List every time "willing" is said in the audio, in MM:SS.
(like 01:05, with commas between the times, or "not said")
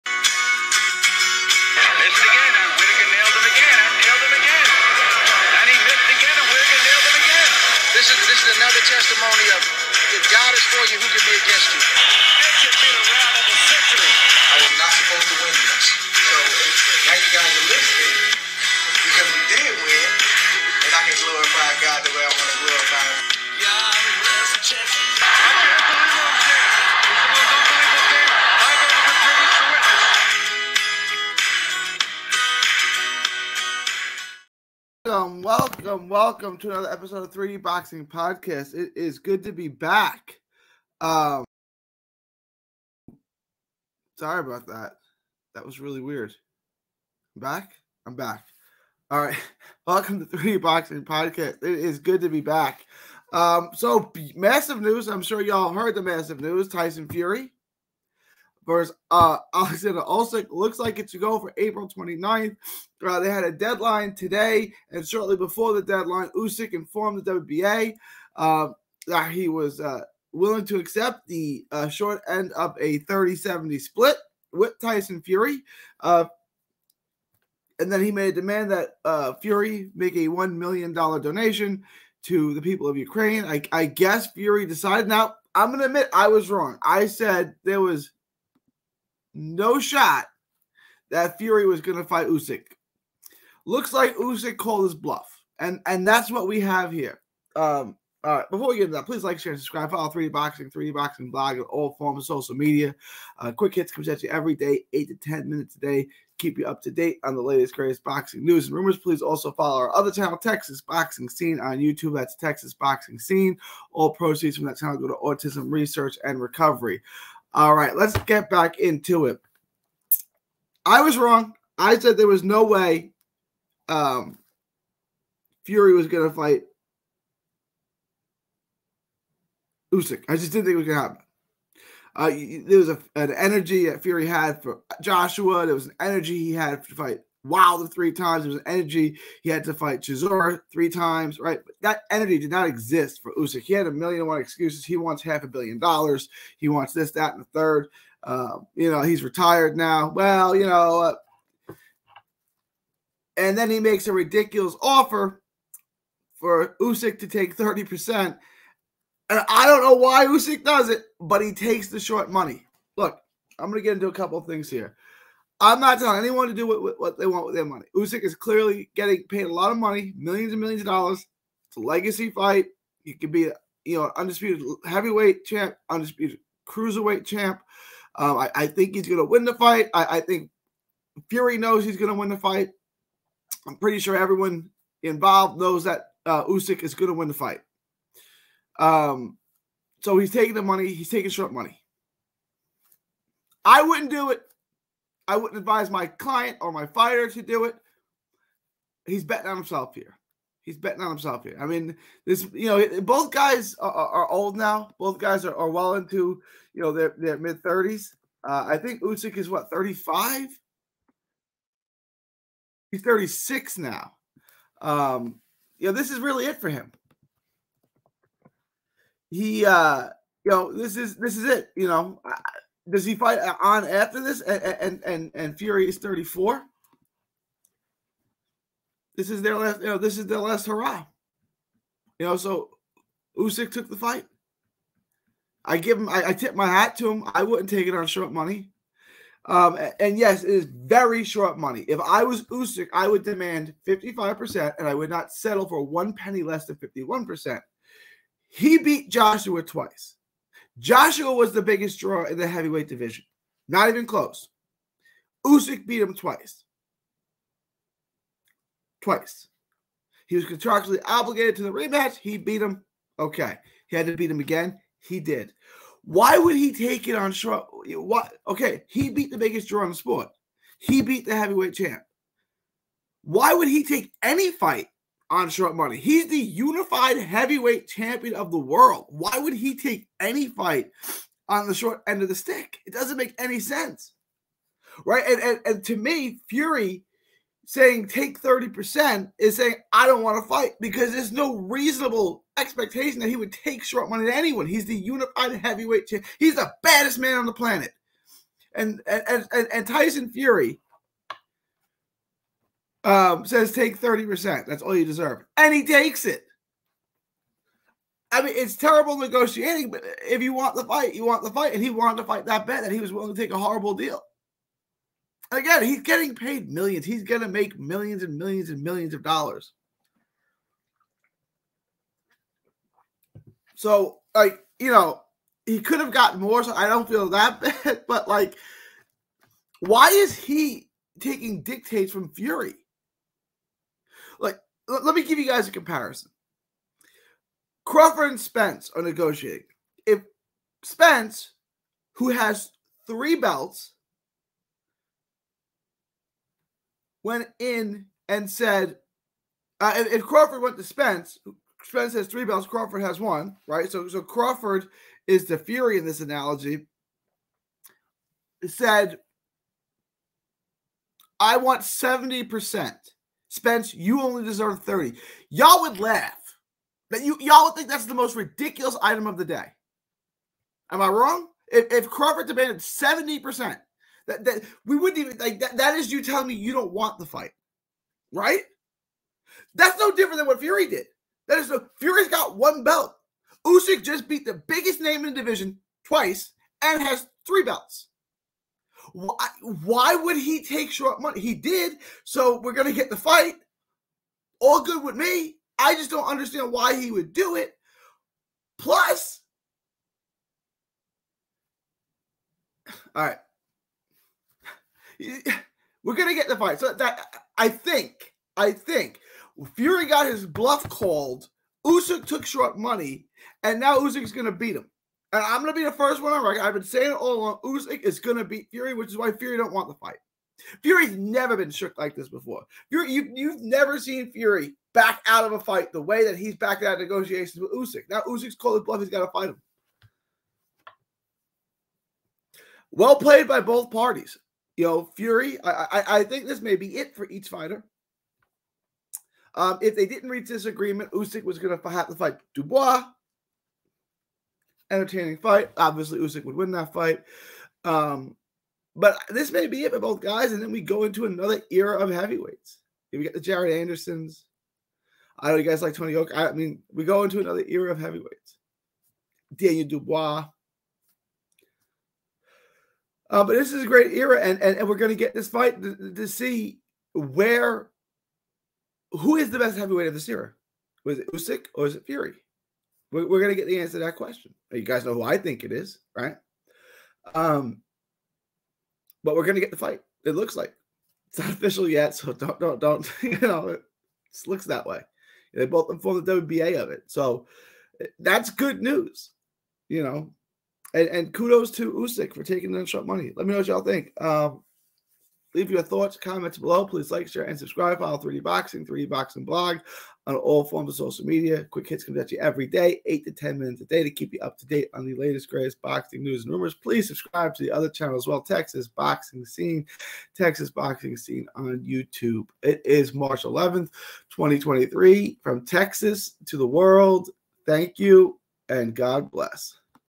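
01:10, 05:13.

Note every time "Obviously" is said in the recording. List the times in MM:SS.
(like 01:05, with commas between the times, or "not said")
07:25.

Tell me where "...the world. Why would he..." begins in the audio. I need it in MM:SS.
04:38.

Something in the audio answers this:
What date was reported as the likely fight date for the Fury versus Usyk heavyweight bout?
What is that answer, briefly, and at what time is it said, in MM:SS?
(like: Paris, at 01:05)
April 29th, at 01:01.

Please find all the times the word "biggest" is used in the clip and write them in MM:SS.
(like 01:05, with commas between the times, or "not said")
04:11, 04:29, 06:24.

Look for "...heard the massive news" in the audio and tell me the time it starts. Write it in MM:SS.
00:55.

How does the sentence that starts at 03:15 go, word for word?
I wouldn't advise my client or my fighter to do it.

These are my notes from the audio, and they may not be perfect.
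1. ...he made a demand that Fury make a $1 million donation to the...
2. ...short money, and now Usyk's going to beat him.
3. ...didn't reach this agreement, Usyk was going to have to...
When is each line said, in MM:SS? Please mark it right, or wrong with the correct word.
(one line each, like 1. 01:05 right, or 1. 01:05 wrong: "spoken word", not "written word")
1. 01:18 right
2. 06:52 right
3. 07:20 right.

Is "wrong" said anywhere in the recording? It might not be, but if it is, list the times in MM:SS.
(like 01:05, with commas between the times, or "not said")
01:26, 02:01, 06:11.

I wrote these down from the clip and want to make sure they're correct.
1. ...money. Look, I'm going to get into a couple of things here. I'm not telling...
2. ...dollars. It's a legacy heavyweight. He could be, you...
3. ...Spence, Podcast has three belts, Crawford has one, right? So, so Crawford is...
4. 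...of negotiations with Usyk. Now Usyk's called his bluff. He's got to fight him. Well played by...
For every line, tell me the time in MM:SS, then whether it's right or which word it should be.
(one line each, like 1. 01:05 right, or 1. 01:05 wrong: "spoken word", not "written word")
1. 02:42 right
2. 02:50 wrong: "fight", not "heavyweight"
3. 05:50 wrong: "Spence", not "Podcast"
4. 07:06 right.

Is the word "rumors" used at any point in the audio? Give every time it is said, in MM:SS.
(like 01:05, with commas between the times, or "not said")
01:48, 08:26.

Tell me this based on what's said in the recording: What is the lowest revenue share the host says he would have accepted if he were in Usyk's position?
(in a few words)
51%.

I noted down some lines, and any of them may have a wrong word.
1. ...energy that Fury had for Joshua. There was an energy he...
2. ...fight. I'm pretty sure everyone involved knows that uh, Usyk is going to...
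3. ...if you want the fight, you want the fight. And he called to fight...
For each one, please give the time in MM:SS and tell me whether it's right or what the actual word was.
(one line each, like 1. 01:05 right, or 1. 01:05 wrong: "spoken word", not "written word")
1. 02:13 right
2. 03:02 right
3. 05:10 wrong: "wanted", not "called".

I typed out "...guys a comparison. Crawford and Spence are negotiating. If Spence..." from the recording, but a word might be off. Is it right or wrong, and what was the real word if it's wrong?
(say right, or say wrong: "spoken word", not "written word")
right.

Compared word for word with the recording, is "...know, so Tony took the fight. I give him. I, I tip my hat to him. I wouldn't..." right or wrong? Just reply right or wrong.
wrong.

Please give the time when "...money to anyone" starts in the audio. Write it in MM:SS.
04:54.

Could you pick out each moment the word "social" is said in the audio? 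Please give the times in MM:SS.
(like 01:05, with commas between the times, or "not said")
01:42, 08:20.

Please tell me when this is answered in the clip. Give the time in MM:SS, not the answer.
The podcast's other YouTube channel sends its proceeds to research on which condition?
01:55.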